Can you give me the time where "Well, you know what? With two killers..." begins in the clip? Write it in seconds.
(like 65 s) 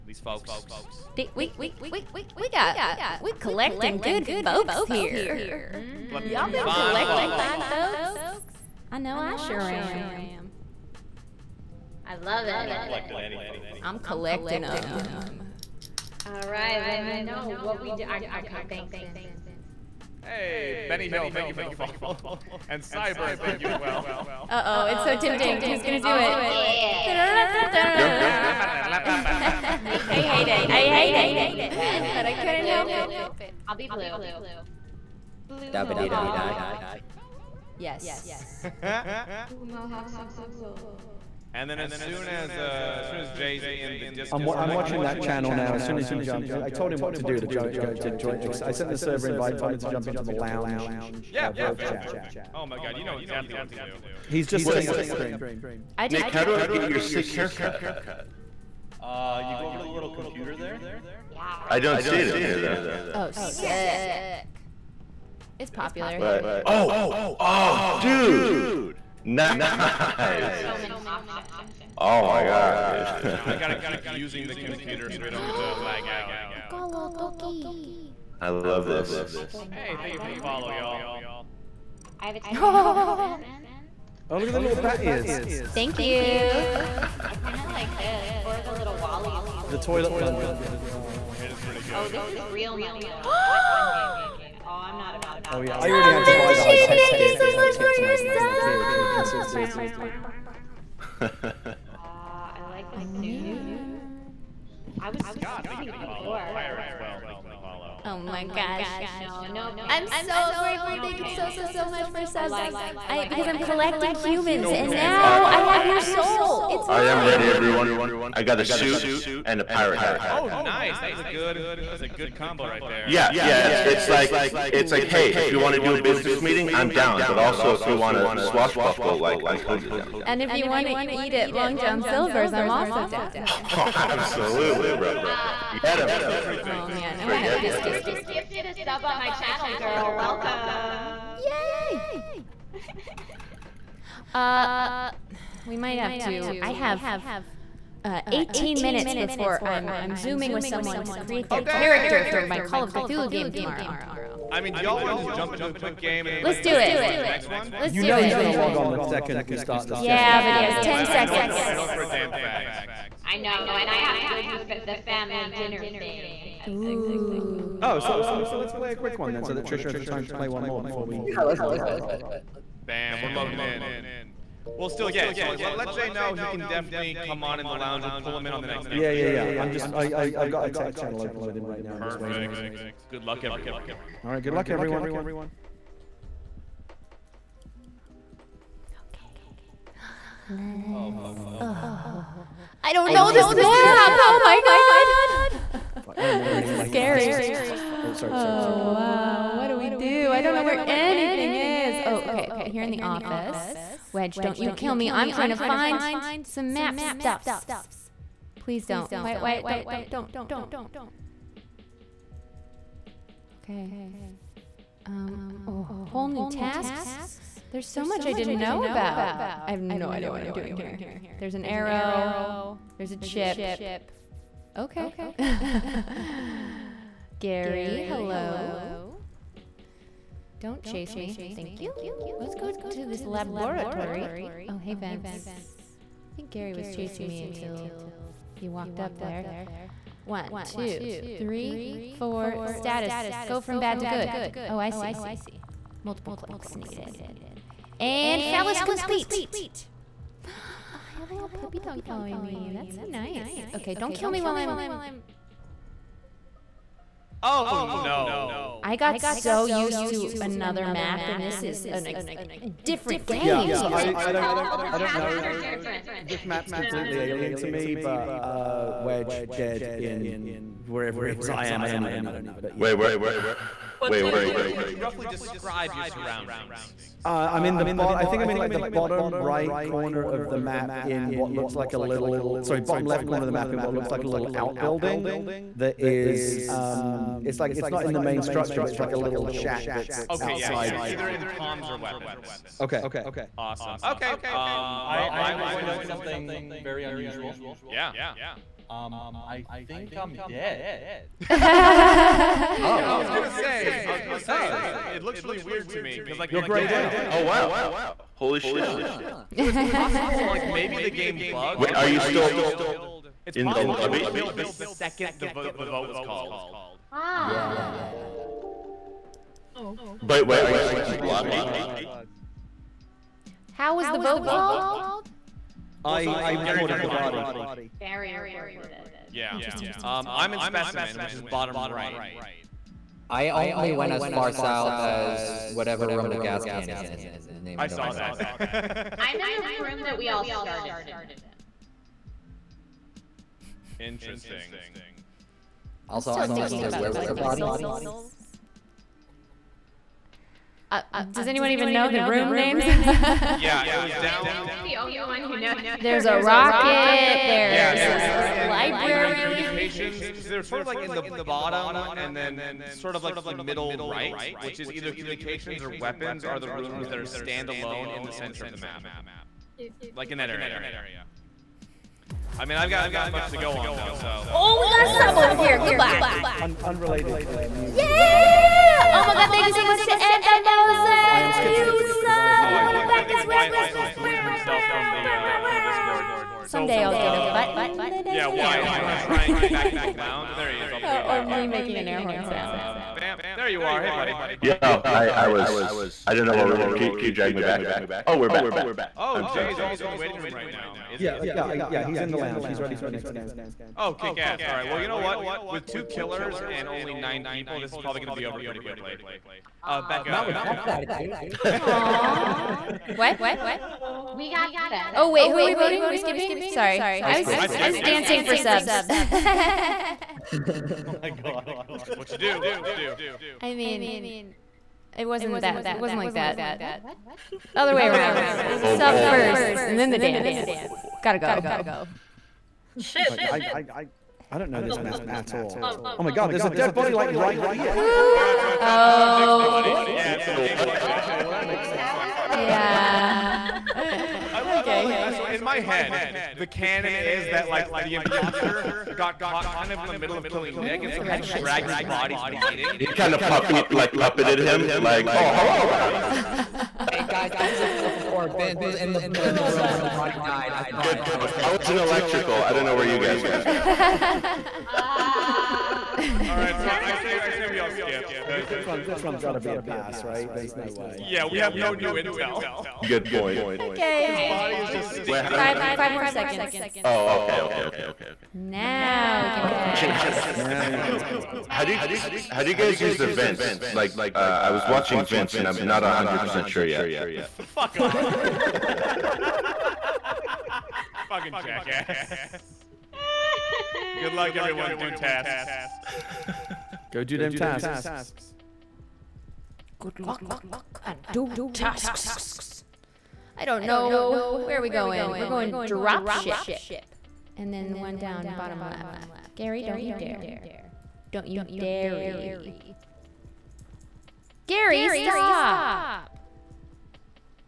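404 s.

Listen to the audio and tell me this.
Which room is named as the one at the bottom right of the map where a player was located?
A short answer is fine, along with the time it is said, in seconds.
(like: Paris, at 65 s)
Specimen, at 330 s.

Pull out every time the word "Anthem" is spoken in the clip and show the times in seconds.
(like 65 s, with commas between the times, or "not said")
380 s.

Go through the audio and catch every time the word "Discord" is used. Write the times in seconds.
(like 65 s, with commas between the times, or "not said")
44 s, 385 s.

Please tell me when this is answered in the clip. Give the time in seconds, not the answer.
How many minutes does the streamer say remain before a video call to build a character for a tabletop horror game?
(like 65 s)
148 s.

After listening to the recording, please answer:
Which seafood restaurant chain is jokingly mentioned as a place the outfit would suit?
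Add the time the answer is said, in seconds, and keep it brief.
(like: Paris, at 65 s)
Long John Silver's, at 131 s.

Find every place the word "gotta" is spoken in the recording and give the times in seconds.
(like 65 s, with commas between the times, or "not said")
73 s, 431 s.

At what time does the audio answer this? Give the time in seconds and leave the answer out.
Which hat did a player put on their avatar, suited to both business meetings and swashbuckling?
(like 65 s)
119 s.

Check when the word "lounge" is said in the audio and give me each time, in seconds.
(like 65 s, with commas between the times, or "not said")
50 s, 177 s, 390 s, 402 s.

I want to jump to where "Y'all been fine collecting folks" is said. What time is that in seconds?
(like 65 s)
6 s.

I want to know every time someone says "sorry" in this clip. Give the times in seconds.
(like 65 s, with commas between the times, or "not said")
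198 s, 282 s, 399 s, 416 s.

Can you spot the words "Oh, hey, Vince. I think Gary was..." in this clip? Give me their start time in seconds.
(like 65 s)
234 s.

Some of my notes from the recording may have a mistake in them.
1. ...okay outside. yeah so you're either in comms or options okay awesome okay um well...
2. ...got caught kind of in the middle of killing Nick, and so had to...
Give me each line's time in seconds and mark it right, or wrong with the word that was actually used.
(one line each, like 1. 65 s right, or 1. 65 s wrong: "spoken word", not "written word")
1. 290 s wrong: "weapons", not "options"
2. 449 s right.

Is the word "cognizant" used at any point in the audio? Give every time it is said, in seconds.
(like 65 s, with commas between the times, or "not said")
not said.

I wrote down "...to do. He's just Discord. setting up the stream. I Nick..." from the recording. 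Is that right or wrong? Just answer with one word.
wrong.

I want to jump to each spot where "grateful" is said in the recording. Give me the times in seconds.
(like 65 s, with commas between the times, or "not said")
110 s.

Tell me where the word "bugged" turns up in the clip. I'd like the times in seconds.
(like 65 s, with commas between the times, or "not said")
311 s, 440 s.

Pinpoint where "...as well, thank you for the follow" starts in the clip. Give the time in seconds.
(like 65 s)
106 s.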